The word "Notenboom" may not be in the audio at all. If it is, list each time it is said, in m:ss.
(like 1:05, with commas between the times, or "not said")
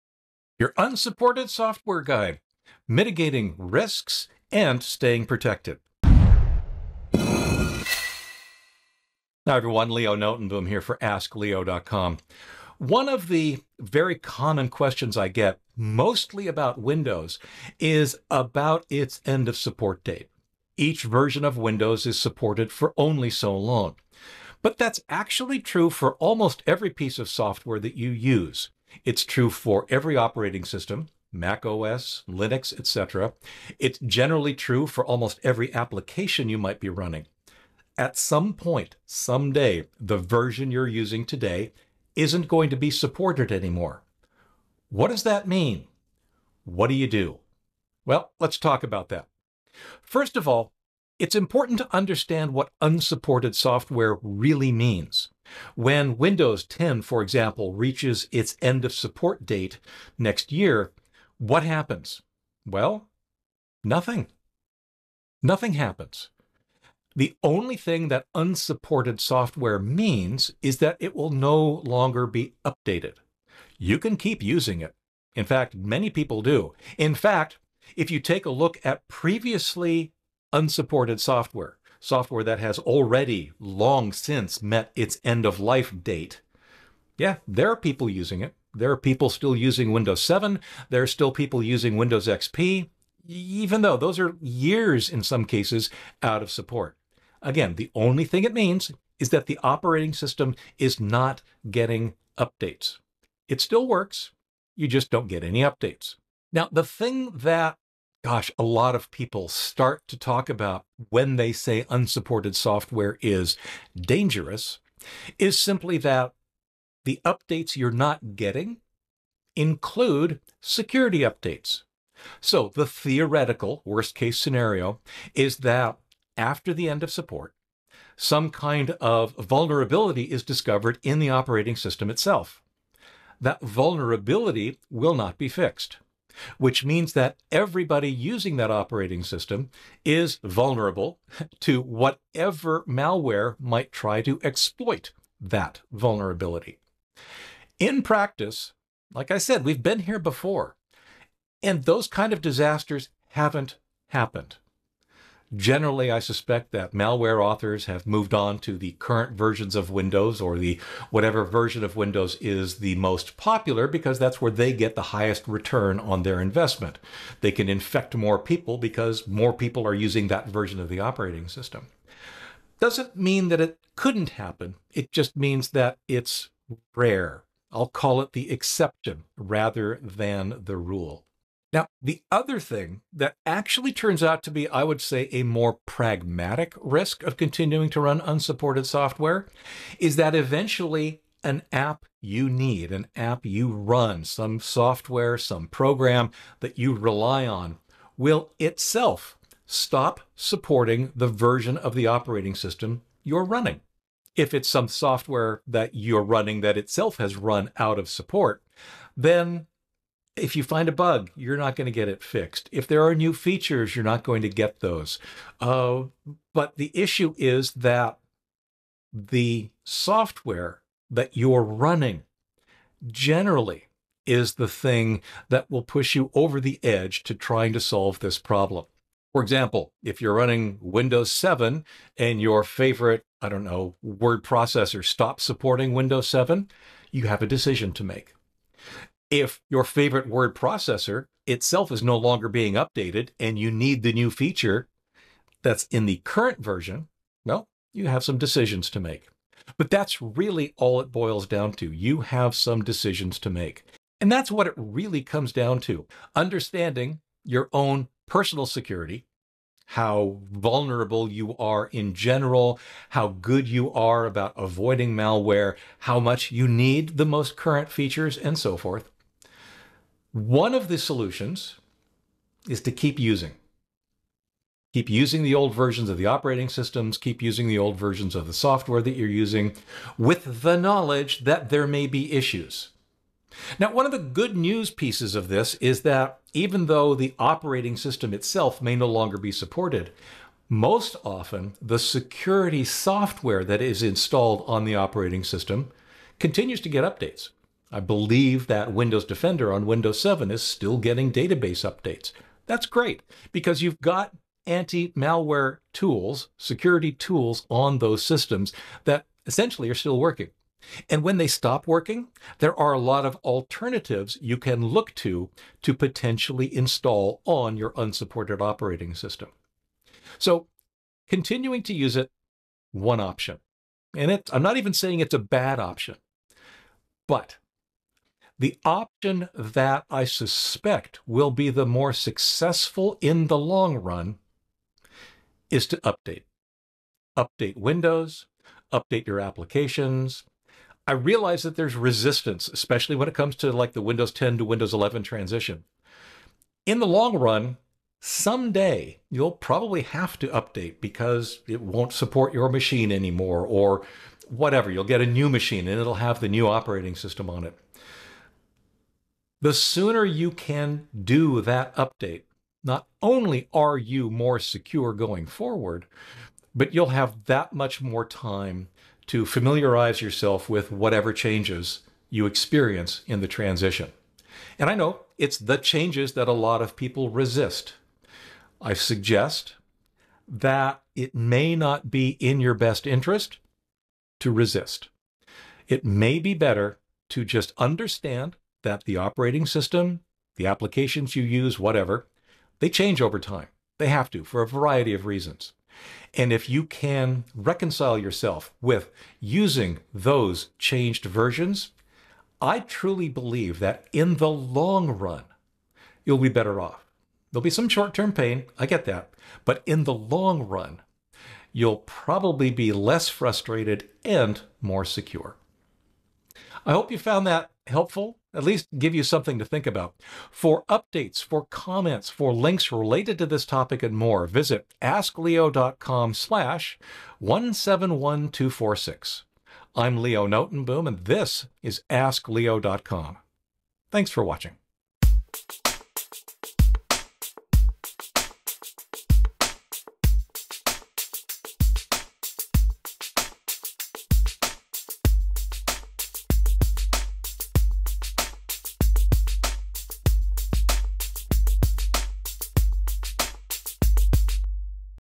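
0:10, 7:10.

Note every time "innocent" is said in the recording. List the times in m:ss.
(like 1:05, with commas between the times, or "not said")
not said.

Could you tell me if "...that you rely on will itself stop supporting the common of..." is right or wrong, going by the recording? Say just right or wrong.
wrong.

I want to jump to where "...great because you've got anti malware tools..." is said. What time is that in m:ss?
5:02.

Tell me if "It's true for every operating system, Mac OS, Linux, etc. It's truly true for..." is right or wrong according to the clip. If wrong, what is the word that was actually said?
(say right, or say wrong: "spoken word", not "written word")
wrong: "generally", not "truly".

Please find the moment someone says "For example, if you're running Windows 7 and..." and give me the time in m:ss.
3:49.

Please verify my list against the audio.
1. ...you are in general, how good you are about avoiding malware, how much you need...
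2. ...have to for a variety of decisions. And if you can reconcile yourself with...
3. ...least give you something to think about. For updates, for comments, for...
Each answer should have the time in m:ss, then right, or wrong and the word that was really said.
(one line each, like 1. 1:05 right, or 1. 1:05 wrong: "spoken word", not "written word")
1. 4:21 right
2. 6:34 wrong: "reasons", not "decisions"
3. 6:58 right.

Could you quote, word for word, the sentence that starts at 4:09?
But that's really all it boils down to.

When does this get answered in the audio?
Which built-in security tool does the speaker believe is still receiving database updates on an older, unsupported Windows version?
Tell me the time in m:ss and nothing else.
4:58.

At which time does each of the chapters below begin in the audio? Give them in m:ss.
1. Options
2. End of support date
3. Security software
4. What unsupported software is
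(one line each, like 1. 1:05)
1. 4:20
2. 0:15
3. 4:50
4. 0:50.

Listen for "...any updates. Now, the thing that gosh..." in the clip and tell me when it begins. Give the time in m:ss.
1:45.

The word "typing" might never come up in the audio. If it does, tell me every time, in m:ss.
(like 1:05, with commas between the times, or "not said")
not said.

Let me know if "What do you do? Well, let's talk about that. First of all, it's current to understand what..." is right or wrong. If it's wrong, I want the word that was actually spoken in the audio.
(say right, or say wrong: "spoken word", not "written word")
wrong: "important", not "current".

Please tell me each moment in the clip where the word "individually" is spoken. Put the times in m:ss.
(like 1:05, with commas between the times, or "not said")
not said.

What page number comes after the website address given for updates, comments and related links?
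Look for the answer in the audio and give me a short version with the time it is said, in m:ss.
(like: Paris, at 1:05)
171246, at 7:07.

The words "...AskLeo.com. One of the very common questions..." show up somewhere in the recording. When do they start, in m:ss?
0:10.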